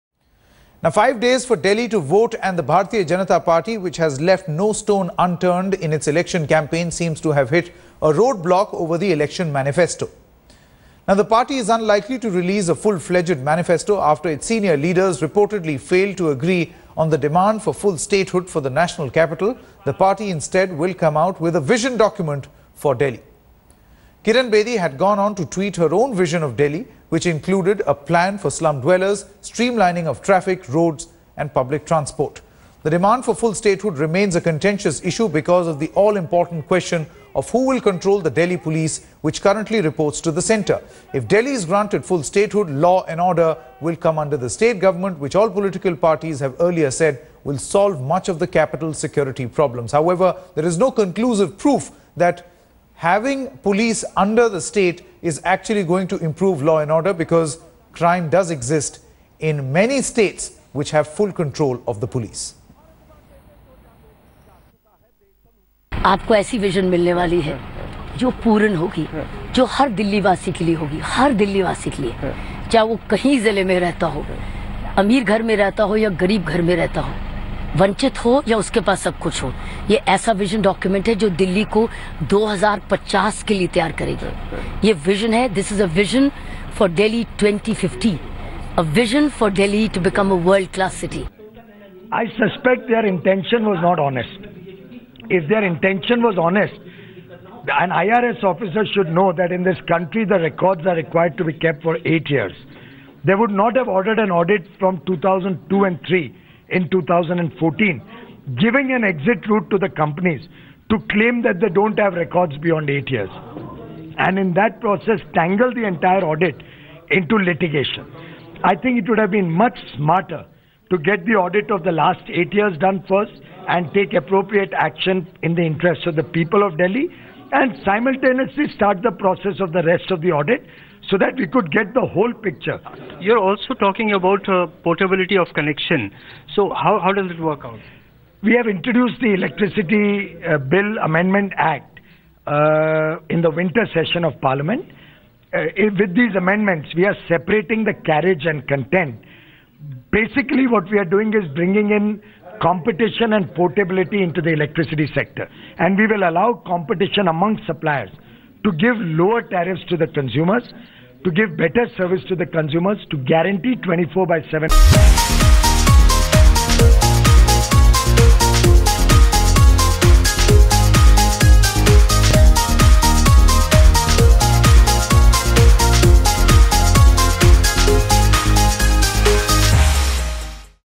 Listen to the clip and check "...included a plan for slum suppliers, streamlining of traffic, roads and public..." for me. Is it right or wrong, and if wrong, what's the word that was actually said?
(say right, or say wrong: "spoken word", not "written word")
wrong: "dwellers", not "suppliers".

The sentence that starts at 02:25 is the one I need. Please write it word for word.
Uh, with these amendments, we are separating the carriage and content.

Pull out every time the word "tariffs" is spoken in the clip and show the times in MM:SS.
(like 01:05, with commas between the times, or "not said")
02:39.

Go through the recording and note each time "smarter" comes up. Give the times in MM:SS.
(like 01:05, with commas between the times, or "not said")
01:59.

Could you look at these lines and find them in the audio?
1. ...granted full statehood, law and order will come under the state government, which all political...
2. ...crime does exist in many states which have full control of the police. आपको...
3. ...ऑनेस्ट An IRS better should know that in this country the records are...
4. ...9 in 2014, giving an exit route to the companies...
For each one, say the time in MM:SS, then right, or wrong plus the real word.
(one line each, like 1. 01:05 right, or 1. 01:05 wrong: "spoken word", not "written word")
1. 00:41 right
2. 00:57 right
3. 01:36 wrong: "officer", not "better"
4. 01:46 wrong: "3", not "9".